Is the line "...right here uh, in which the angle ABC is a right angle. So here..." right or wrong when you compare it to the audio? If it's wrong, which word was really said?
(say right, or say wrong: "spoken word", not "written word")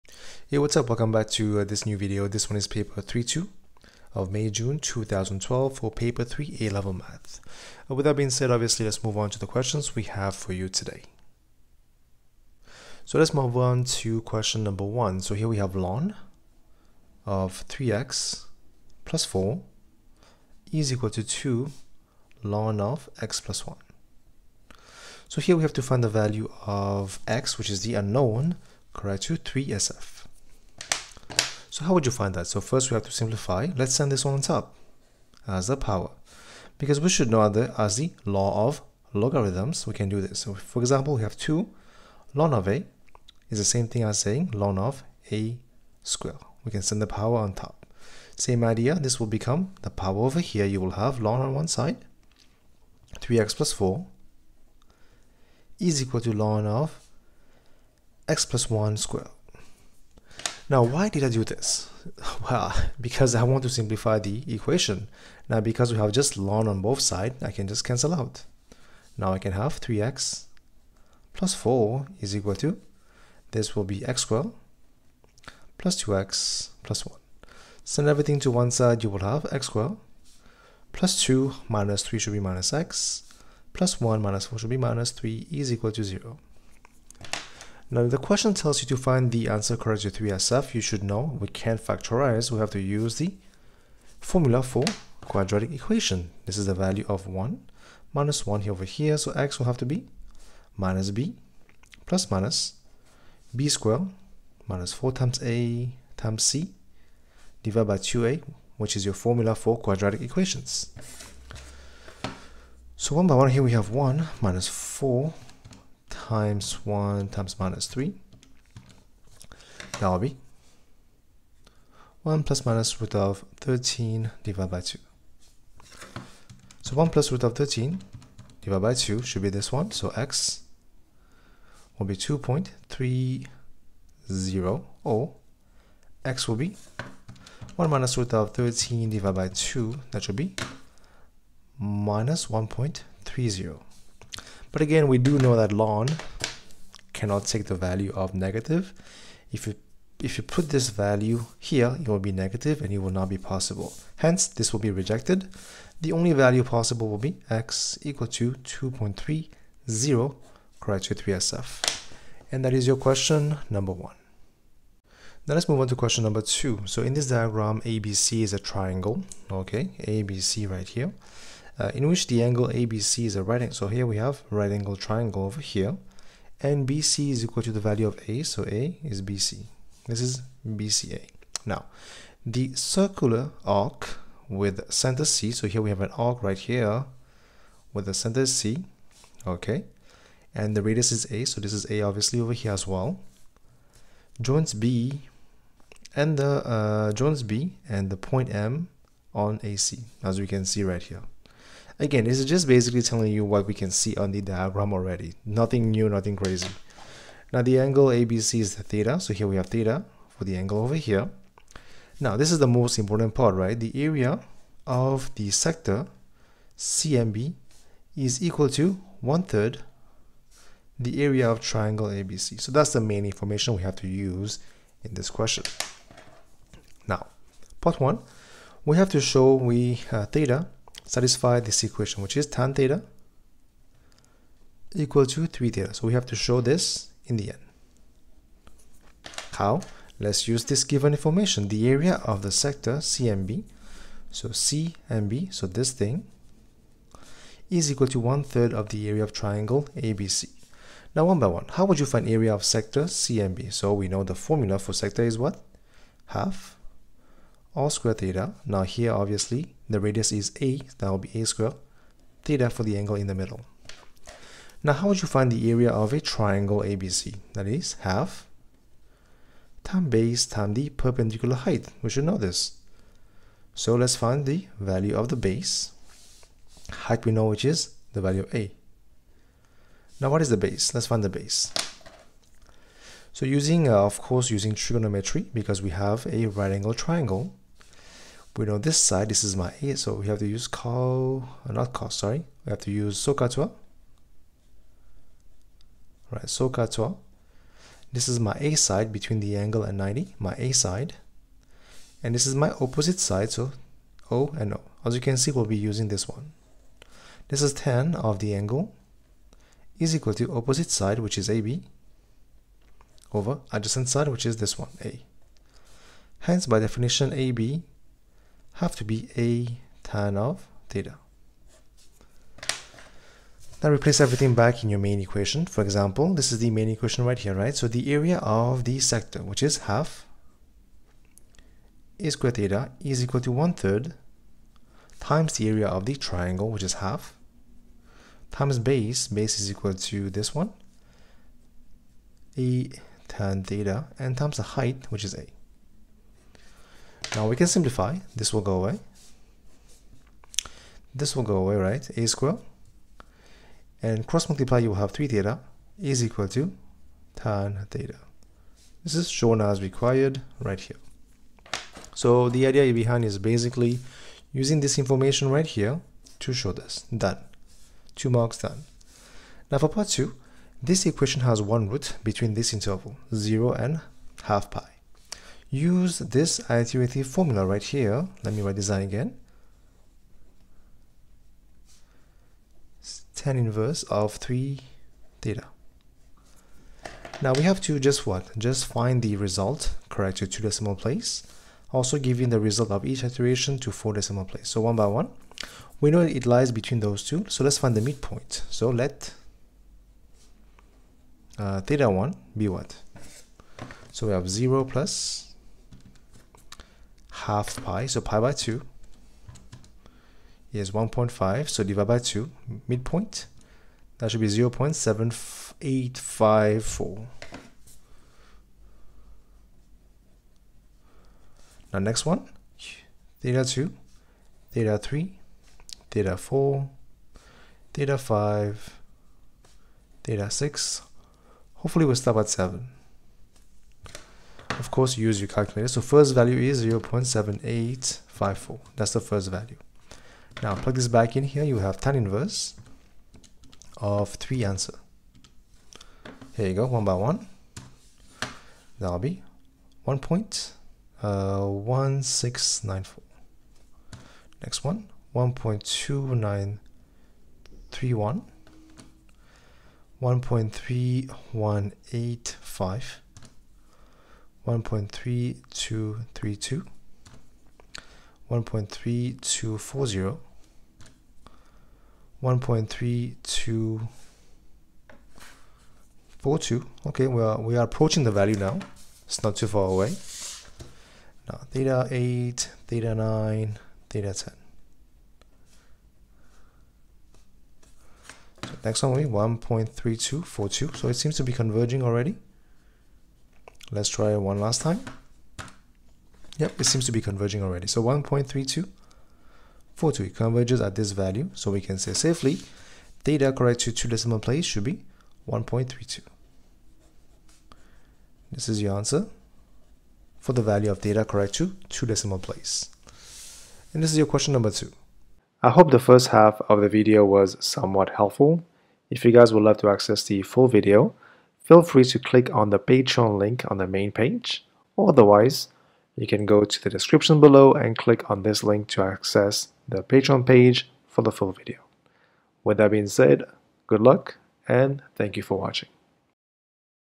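right.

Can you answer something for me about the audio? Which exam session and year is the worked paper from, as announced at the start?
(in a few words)
May, June 2012.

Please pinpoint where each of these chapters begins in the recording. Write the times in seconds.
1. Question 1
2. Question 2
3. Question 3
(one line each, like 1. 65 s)
1. 12 s
2. 164 s
3. 515 s.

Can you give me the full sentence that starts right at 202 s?
Again, this is just basically telling you what we can see on the diagram already.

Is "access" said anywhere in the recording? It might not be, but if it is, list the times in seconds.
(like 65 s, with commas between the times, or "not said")
519 s, 529 s.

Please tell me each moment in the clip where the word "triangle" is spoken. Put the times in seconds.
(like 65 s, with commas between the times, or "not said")
168 s, 174 s, 221 s, 249 s, 266 s, 286 s, 336 s.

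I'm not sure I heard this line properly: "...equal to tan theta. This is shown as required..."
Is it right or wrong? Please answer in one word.
right.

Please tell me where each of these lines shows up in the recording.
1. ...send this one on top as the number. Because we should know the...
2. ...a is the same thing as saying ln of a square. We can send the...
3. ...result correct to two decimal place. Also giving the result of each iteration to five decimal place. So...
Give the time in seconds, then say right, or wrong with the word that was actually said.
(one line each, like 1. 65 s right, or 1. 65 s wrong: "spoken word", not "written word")
1. 33 s wrong: "power", not "number"
2. 42 s right
3. 389 s wrong: "four", not "five".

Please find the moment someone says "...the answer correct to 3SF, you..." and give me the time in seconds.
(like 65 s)
89 s.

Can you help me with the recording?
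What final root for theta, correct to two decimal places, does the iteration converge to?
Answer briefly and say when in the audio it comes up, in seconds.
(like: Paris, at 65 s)
1.32, at 505 s.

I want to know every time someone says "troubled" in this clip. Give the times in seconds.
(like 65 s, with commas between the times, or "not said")
not said.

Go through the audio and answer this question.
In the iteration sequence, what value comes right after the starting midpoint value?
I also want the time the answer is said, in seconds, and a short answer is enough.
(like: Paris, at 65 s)
1.1694, at 450 s.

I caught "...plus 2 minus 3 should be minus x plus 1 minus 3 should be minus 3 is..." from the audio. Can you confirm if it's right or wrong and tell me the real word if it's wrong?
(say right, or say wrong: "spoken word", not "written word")
wrong: "4", not "3".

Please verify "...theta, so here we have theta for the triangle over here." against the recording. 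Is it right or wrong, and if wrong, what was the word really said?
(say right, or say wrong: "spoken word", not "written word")
wrong: "angle", not "triangle".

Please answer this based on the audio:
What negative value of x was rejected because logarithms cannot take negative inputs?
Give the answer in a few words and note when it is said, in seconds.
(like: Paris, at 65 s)
-1.30, at 141 s.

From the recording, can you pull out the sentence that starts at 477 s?
Okay, are we are approaching the value now.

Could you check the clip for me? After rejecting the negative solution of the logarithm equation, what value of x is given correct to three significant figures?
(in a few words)
2.30.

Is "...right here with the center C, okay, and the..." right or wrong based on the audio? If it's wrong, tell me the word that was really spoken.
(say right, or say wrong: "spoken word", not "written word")
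right.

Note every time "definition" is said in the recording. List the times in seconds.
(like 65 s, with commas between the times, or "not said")
316 s.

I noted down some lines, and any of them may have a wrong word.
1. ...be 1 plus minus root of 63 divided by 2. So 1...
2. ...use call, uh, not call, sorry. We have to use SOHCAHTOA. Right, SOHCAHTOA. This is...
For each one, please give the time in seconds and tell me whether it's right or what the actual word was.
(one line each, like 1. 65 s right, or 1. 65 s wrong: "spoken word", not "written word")
1. 120 s wrong: "13", not "63"
2. 290 s right.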